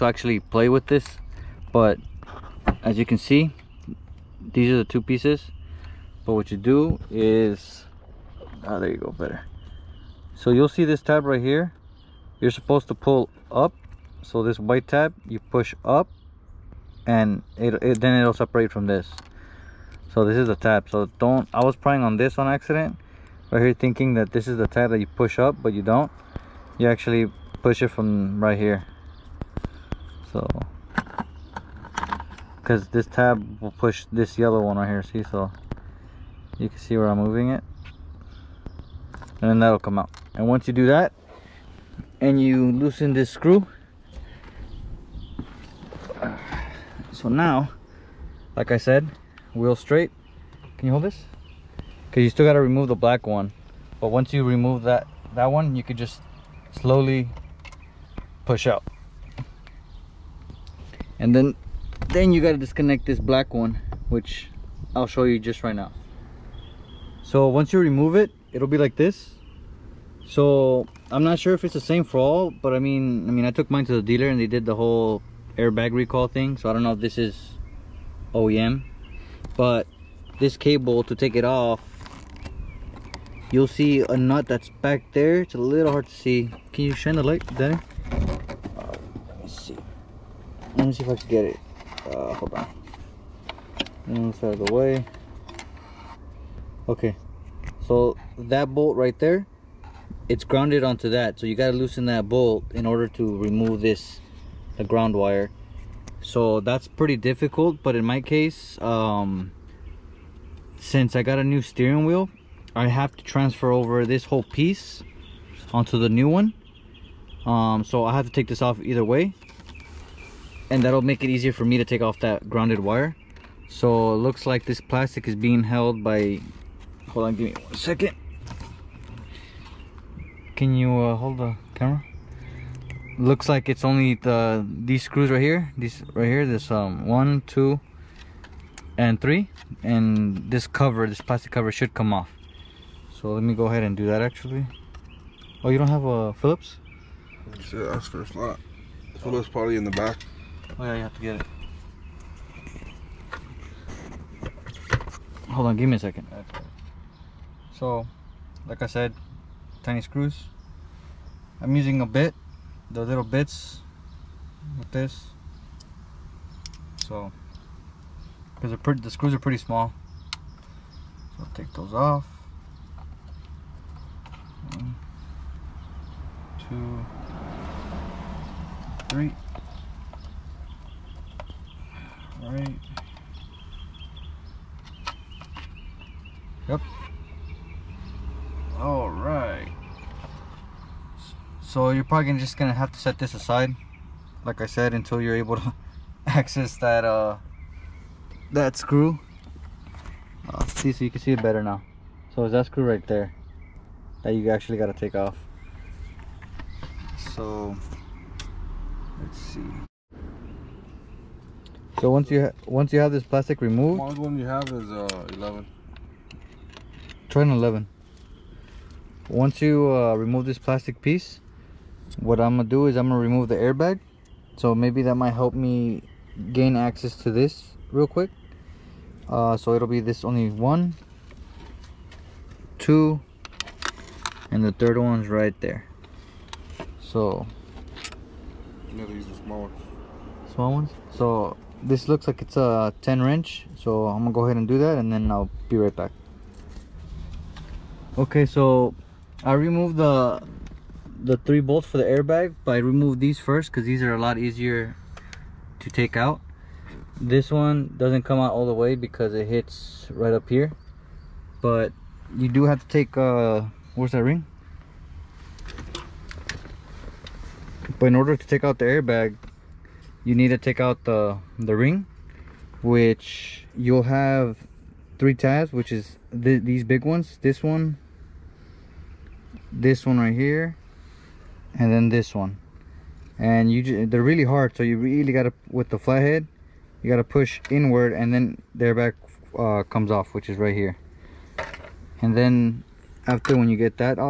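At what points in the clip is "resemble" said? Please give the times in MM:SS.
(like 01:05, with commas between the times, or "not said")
not said.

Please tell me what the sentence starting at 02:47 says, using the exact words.
So, because the screws are pretty small.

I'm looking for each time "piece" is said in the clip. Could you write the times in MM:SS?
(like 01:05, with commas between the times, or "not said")
00:05, 01:54, 03:41.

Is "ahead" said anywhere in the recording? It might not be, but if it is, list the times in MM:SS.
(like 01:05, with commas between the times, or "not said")
02:23, 04:04.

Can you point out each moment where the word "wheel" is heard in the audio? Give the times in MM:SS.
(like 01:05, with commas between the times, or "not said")
00:49, 01:52.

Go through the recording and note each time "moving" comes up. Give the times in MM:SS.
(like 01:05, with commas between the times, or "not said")
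00:37.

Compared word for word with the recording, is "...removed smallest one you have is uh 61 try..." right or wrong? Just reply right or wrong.
wrong.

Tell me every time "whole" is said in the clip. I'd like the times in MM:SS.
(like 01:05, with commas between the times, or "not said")
01:14, 01:54.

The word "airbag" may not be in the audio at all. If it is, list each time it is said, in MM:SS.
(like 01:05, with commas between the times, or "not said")
01:15, 03:43, 04:12, 04:28, 04:48.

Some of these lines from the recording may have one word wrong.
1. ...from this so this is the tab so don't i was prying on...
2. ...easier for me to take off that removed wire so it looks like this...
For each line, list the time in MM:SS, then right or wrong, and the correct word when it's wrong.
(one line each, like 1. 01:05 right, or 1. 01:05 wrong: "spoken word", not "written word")
1. 00:18 right
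2. 02:01 wrong: "grounded", not "removed".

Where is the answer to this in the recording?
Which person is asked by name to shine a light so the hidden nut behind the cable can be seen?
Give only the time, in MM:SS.
01:27.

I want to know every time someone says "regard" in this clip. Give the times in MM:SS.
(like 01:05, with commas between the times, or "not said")
not said.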